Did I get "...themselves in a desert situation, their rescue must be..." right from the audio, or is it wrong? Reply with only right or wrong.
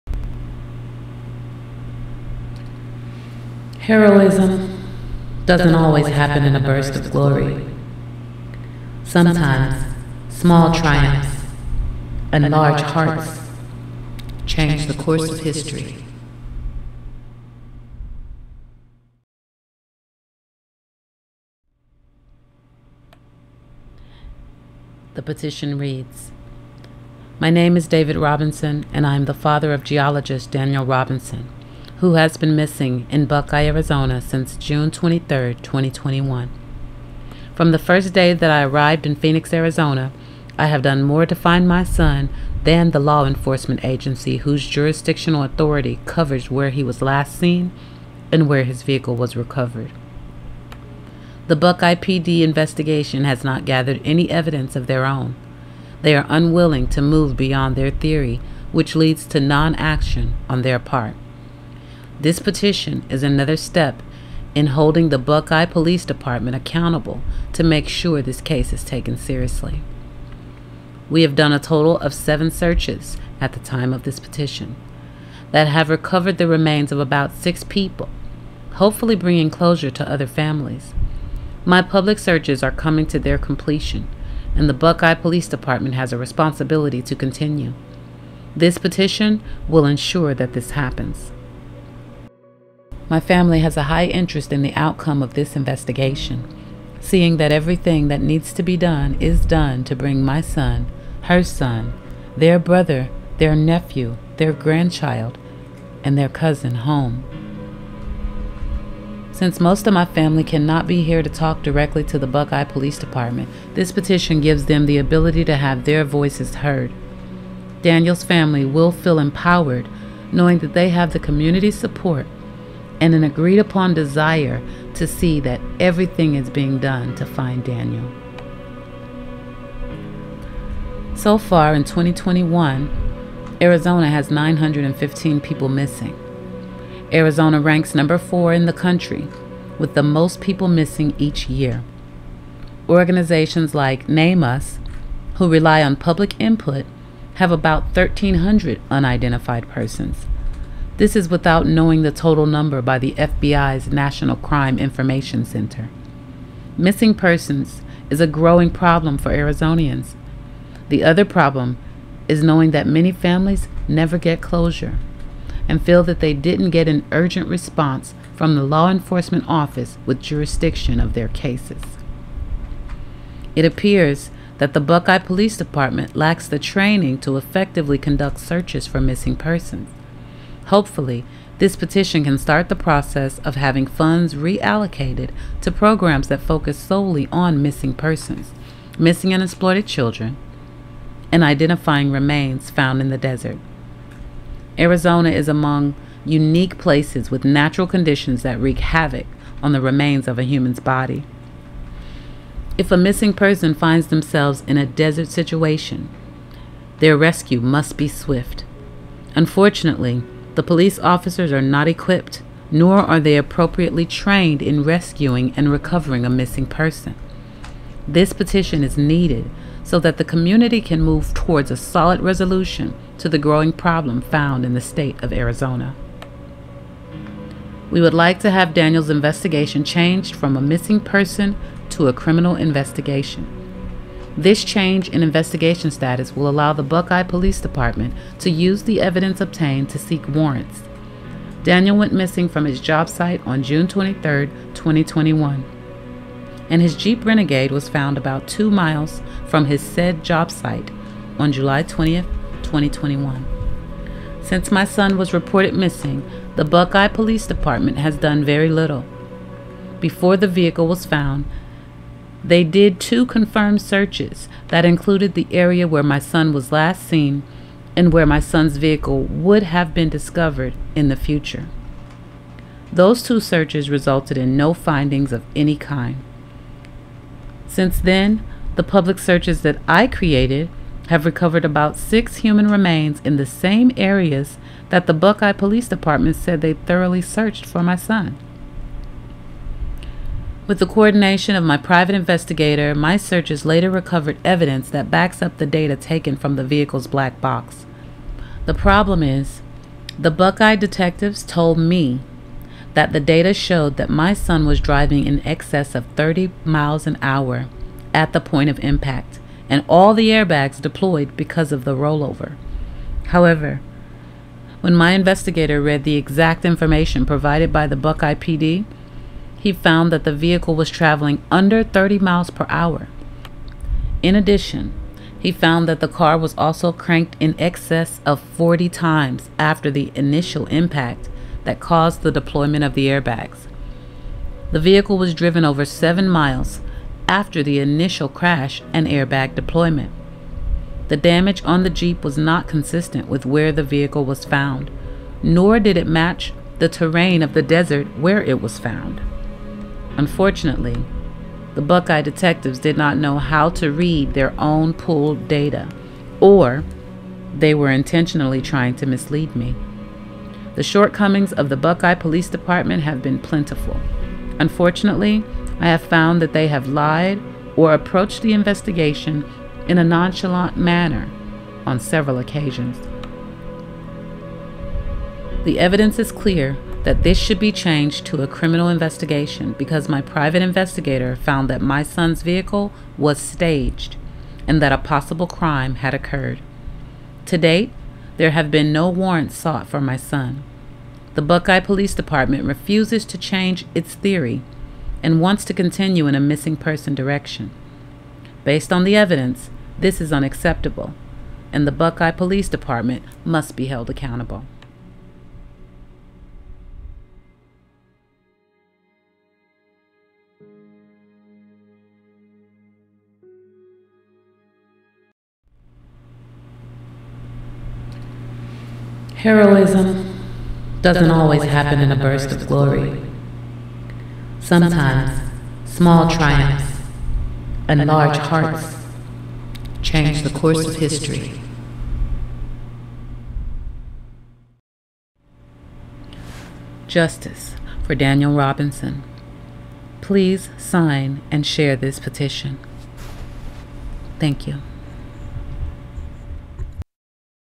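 right.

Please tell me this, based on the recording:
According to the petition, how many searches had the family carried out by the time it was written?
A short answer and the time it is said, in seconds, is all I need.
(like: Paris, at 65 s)
7, at 72 s.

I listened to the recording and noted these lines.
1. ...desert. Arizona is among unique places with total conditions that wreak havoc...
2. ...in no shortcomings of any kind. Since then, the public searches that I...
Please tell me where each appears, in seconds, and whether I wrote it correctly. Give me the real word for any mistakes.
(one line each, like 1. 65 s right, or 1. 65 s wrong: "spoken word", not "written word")
1. 193 s wrong: "natural", not "total"
2. 274 s wrong: "findings", not "shortcomings".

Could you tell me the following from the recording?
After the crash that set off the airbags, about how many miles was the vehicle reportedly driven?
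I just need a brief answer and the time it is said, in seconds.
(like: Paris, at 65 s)
7, at 335 s.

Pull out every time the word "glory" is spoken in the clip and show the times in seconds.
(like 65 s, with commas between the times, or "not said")
7 s, 422 s.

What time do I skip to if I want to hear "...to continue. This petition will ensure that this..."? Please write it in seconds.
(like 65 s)
87 s.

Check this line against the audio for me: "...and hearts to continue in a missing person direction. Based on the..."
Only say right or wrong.
wrong.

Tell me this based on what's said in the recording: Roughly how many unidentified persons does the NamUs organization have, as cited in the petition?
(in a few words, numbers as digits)
1,300.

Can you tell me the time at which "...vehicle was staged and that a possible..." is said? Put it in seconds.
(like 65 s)
382 s.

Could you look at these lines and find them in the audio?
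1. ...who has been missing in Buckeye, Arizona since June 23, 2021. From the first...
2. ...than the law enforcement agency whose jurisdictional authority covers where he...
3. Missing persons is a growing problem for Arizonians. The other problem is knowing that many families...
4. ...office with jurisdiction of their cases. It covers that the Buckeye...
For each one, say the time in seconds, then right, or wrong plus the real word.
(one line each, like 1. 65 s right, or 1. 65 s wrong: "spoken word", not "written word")
1. 32 s right
2. 42 s right
3. 156 s right
4. 169 s wrong: "appears", not "covers".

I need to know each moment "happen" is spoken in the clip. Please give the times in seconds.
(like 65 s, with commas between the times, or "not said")
6 s, 90 s, 421 s.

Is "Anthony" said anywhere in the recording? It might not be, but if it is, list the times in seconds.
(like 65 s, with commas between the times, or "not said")
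not said.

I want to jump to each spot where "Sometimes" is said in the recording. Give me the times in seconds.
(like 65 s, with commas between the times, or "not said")
9 s, 424 s.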